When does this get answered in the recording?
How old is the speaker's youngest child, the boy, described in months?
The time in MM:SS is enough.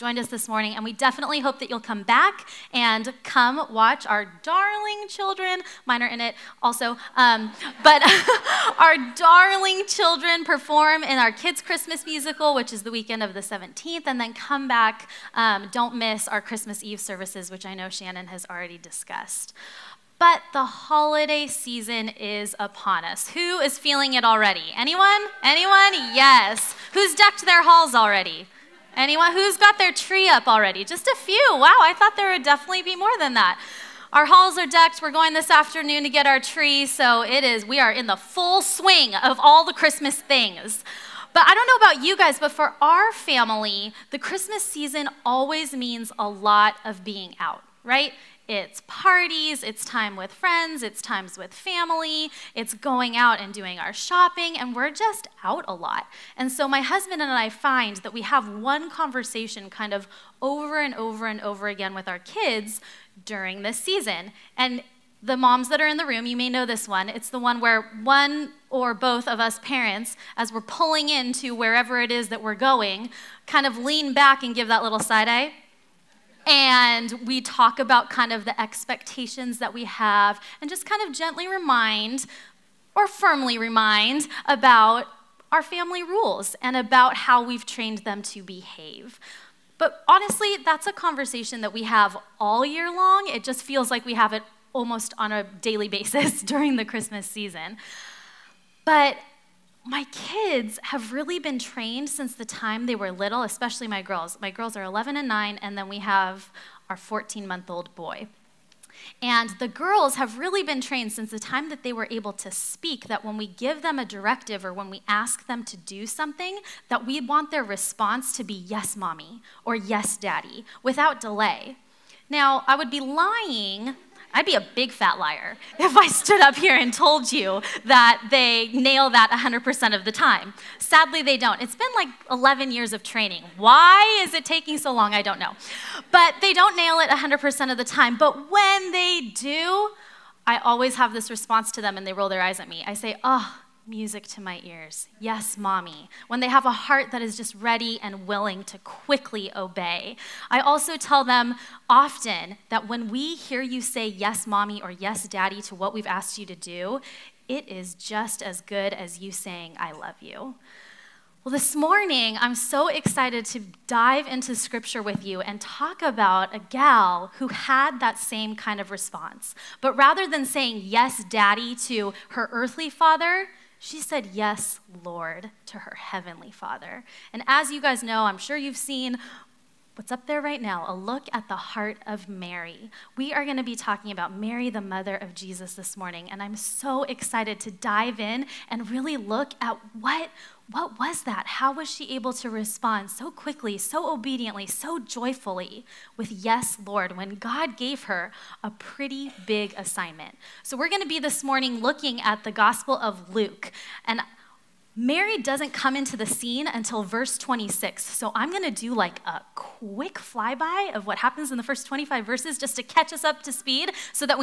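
01:46.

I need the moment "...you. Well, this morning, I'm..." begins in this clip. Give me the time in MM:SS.
02:40.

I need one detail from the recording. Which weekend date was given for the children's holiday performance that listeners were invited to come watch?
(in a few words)
the 17th.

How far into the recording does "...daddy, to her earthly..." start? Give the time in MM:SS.
02:51.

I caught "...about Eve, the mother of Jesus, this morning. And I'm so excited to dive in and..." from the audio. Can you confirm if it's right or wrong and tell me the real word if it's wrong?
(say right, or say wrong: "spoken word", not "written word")
wrong: "Mary", not "Eve".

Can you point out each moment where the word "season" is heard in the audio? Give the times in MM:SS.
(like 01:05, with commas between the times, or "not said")
00:21, 00:44, 01:03, 01:37.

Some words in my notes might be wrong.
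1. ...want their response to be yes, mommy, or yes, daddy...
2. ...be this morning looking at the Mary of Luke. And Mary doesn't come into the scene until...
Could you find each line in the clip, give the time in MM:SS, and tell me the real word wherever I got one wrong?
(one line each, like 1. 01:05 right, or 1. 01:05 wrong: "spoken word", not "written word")
1. 01:57 right
2. 03:21 wrong: "Gospel", not "Mary".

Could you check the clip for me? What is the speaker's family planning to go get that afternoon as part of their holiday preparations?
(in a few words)
Their tree.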